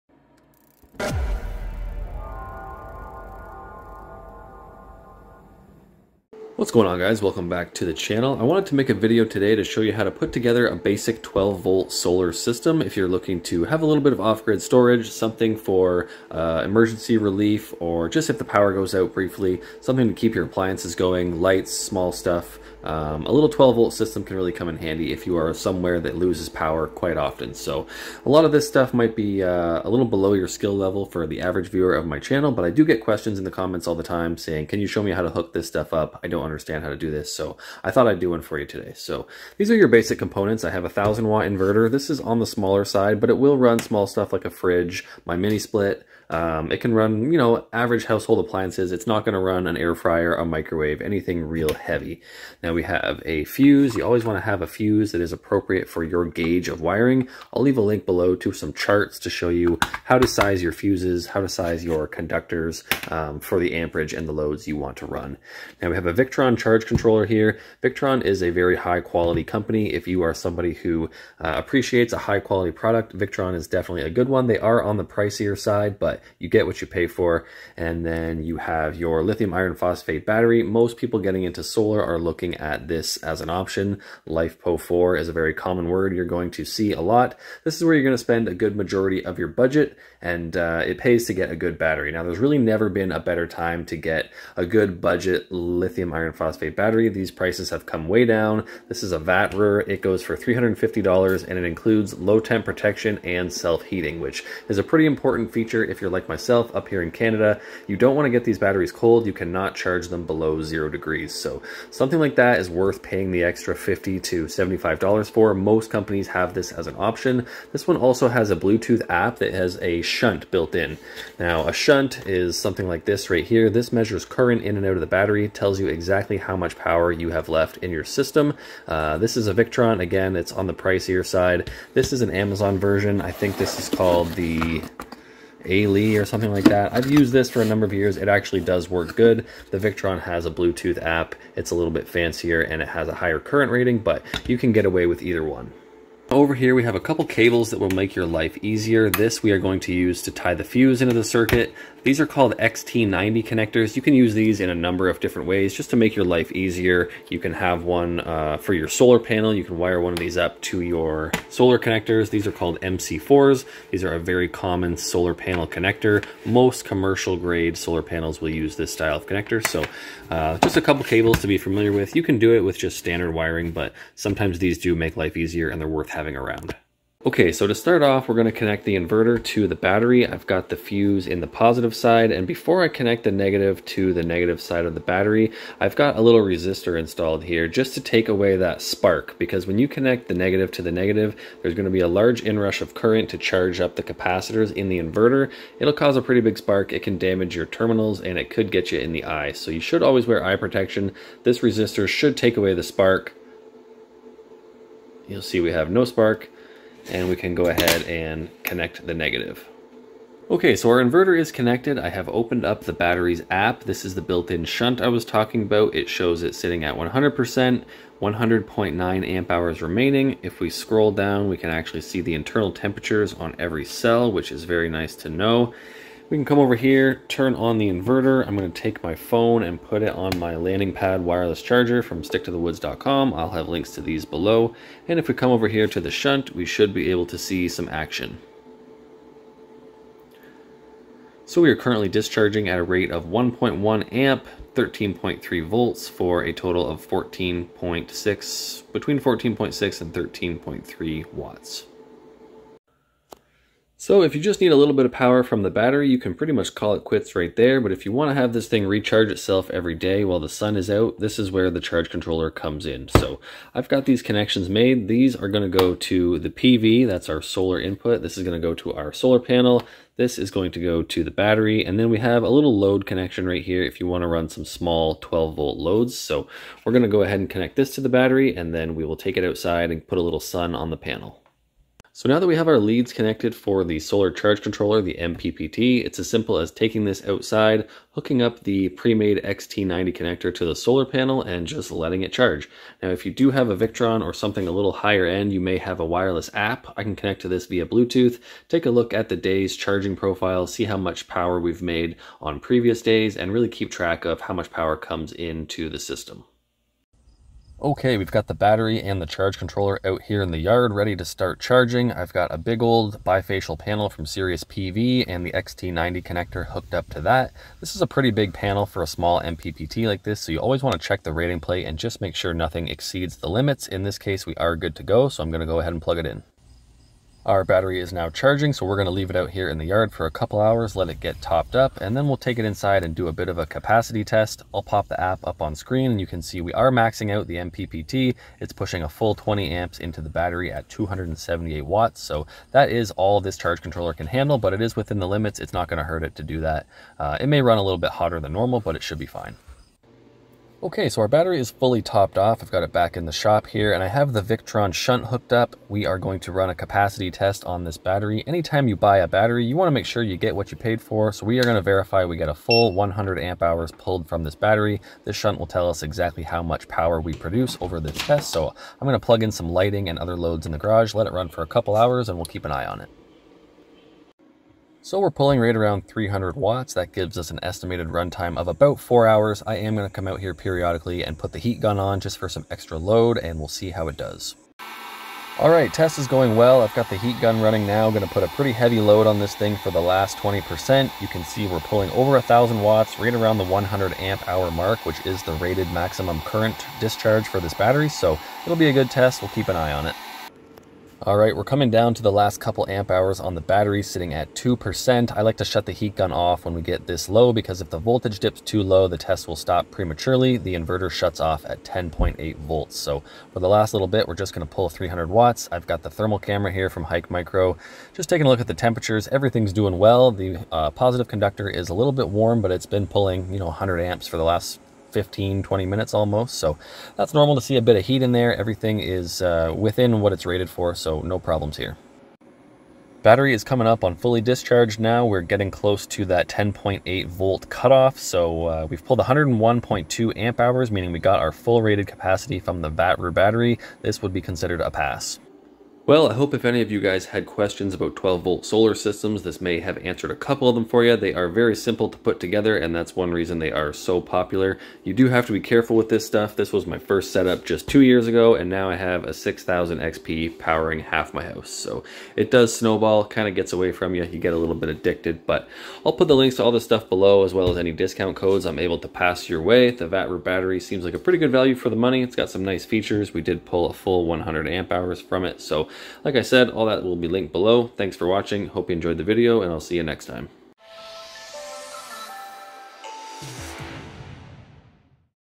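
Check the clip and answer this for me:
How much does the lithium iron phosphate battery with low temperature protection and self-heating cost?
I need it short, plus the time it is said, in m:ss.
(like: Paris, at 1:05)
$350, at 1:40.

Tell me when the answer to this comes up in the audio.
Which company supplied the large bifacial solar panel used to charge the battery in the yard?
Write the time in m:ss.
5:14.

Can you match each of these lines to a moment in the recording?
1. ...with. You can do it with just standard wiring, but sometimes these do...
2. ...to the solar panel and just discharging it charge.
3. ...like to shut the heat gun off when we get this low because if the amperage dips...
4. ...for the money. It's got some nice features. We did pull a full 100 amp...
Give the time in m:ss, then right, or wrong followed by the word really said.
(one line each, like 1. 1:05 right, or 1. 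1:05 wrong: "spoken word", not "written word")
1. 2:51 right
2. 4:50 wrong: "letting", not "discharging"
3. 6:45 wrong: "voltage", not "amperage"
4. 7:51 right.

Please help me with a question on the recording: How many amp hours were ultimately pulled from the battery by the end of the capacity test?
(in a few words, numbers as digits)
101.2 amp hours.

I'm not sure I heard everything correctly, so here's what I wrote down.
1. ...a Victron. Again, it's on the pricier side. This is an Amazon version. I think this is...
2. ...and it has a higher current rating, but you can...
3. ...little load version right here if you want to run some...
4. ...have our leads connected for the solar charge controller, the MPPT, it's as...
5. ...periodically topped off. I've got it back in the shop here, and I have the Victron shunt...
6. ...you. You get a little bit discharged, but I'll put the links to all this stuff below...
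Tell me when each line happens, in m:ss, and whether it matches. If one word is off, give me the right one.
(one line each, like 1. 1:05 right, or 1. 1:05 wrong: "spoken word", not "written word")
1. 2:09 right
2. 2:22 right
3. 4:32 wrong: "connection", not "version"
4. 4:42 right
5. 5:51 wrong: "fully", not "periodically"
6. 7:44 wrong: "addicted", not "discharged".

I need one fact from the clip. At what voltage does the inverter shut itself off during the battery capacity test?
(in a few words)
10.8 volts.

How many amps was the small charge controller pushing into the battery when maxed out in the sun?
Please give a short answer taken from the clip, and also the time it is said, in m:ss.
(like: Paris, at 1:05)
20 amps, at 5:39.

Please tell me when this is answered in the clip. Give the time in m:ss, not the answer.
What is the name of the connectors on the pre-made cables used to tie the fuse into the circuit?
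2:32.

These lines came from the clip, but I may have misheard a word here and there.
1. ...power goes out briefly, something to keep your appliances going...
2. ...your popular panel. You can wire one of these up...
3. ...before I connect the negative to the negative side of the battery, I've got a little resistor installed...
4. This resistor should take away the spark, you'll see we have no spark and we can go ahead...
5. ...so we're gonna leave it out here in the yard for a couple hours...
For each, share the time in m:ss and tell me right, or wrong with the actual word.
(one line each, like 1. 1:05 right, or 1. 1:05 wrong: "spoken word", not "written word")
1. 0:18 right
2. 2:38 wrong: "solar", not "popular"
3. 3:02 right
4. 3:21 right
5. 5:28 right.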